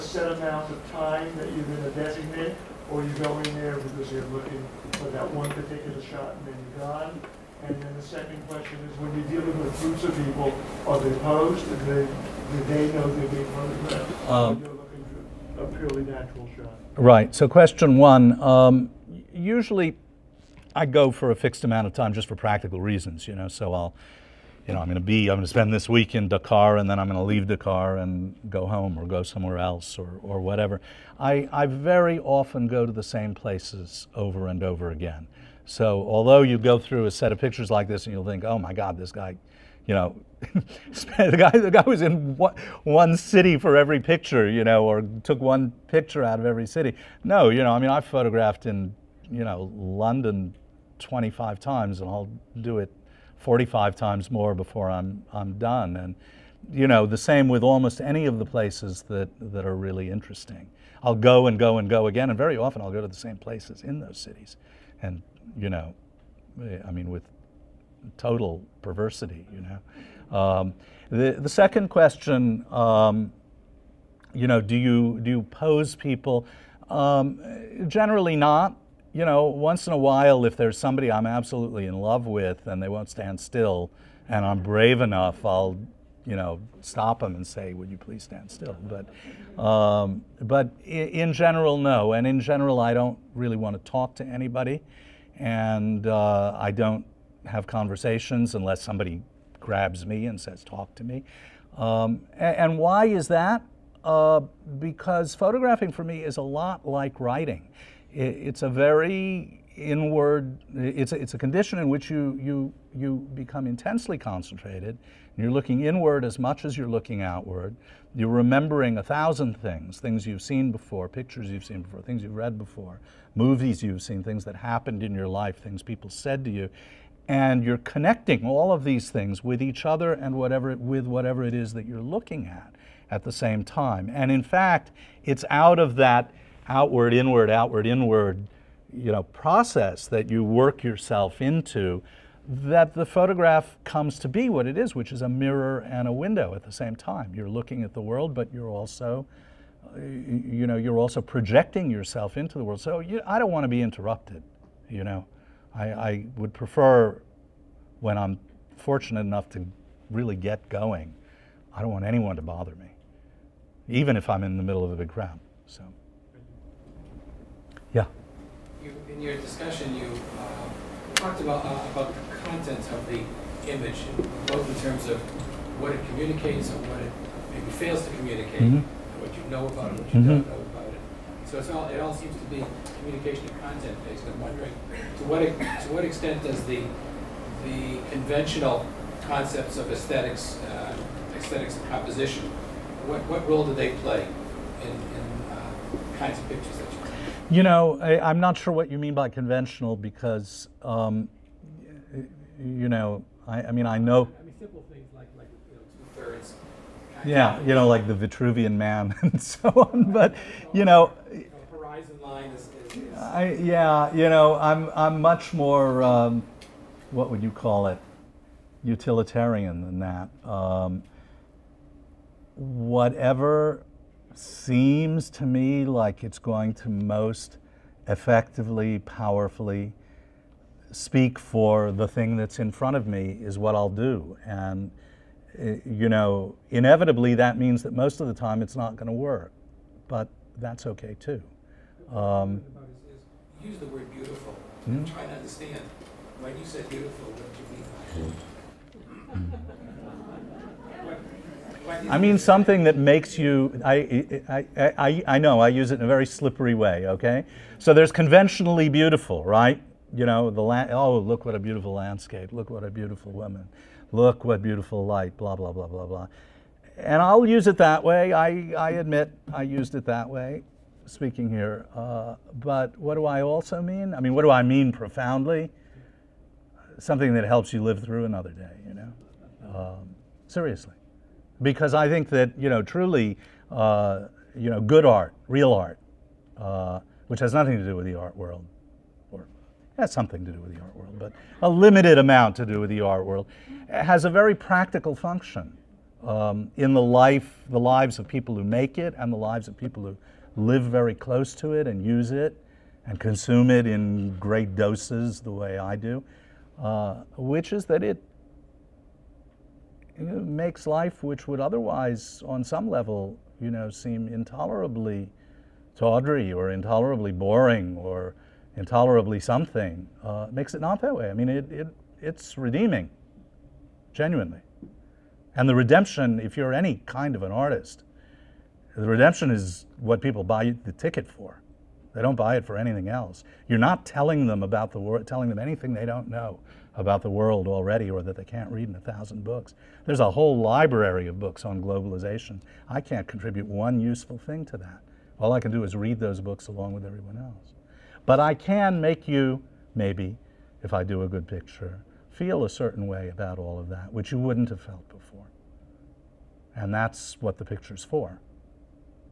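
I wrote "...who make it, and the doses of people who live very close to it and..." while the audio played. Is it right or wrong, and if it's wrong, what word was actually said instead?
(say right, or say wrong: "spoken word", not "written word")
wrong: "lives", not "doses".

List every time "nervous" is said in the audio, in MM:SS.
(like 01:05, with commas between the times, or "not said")
not said.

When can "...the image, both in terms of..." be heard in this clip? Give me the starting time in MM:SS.
02:53.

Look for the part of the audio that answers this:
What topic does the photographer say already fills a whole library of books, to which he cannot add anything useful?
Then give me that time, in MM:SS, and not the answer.
05:41.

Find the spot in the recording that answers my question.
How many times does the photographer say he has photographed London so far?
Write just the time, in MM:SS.
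00:50.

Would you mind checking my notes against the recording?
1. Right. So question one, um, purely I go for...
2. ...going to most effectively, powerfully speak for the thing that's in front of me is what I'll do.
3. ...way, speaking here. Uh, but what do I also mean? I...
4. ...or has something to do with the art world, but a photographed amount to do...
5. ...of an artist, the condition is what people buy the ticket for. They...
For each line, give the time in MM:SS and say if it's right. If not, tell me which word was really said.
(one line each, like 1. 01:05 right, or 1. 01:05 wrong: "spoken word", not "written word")
1. 00:16 wrong: "usually", not "purely"
2. 03:46 right
3. 04:30 right
4. 04:49 wrong: "limited", not "photographed"
5. 05:27 wrong: "redemption", not "condition".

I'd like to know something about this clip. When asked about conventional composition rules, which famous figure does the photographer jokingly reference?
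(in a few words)
the Vitruvian Man.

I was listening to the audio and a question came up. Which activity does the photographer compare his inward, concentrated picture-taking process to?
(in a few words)
writing.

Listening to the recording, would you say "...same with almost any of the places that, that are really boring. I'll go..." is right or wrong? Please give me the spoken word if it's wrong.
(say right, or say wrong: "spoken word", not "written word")
wrong: "interesting", not "boring".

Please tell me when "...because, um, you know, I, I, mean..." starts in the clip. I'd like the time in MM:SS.
03:19.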